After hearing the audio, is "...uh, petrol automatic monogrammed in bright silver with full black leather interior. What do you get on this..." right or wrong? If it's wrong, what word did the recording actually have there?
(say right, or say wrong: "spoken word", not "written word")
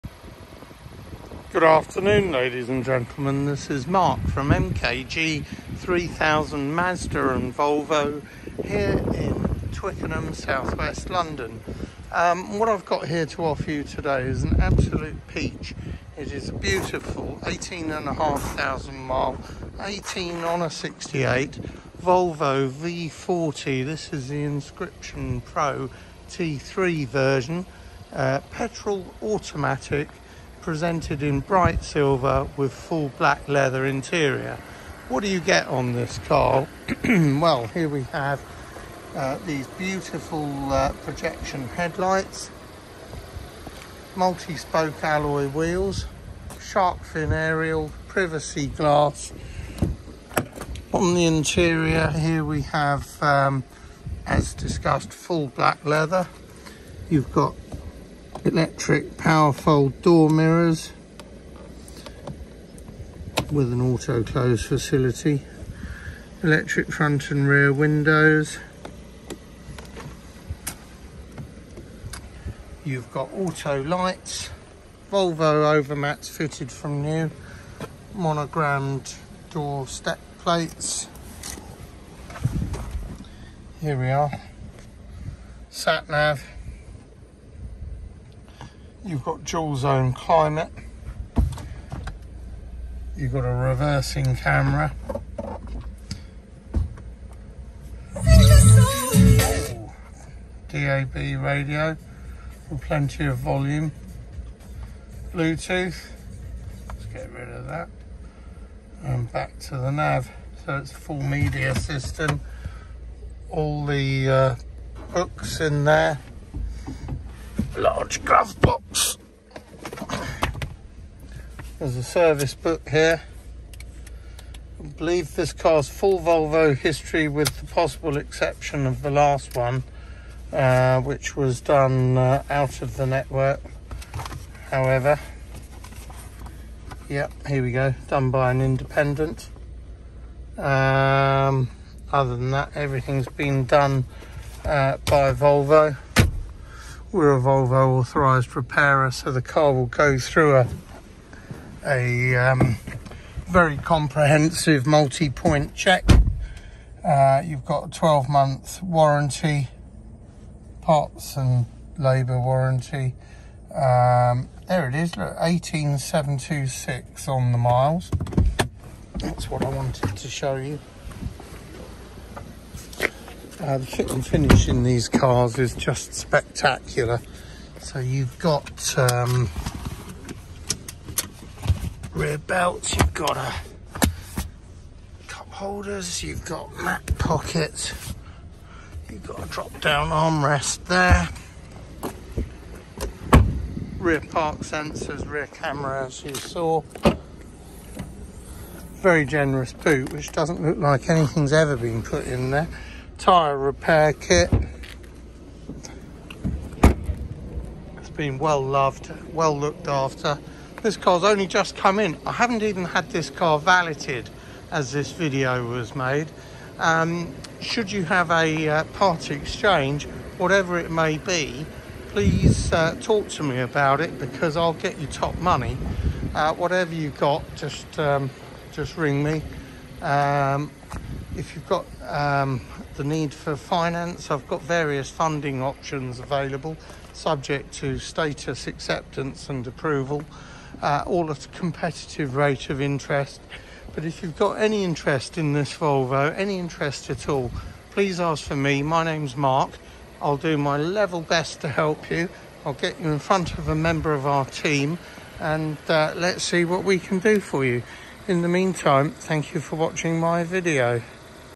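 wrong: "presented", not "monogrammed".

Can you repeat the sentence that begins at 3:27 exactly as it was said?
It's been well loved, well looked after.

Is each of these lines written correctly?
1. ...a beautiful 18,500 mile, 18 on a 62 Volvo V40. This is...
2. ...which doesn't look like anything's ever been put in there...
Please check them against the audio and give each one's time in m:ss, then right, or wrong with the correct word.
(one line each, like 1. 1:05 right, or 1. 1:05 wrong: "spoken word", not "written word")
1. 0:16 wrong: "68", not "62"
2. 3:20 right.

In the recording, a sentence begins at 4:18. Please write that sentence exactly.
In the meantime, thank you for watching my video.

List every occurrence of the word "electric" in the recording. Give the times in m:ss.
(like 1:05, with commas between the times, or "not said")
0:58, 1:06.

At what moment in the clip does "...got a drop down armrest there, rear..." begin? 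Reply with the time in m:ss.
3:09.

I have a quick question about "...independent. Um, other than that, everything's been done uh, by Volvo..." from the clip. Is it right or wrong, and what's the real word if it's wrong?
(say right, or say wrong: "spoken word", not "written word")
right.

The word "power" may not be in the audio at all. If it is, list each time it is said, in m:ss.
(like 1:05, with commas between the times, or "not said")
0:59.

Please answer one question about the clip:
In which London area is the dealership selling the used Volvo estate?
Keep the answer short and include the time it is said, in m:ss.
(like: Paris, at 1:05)
Twickenham, at 0:09.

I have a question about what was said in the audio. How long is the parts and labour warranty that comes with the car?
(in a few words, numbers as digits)
12 months.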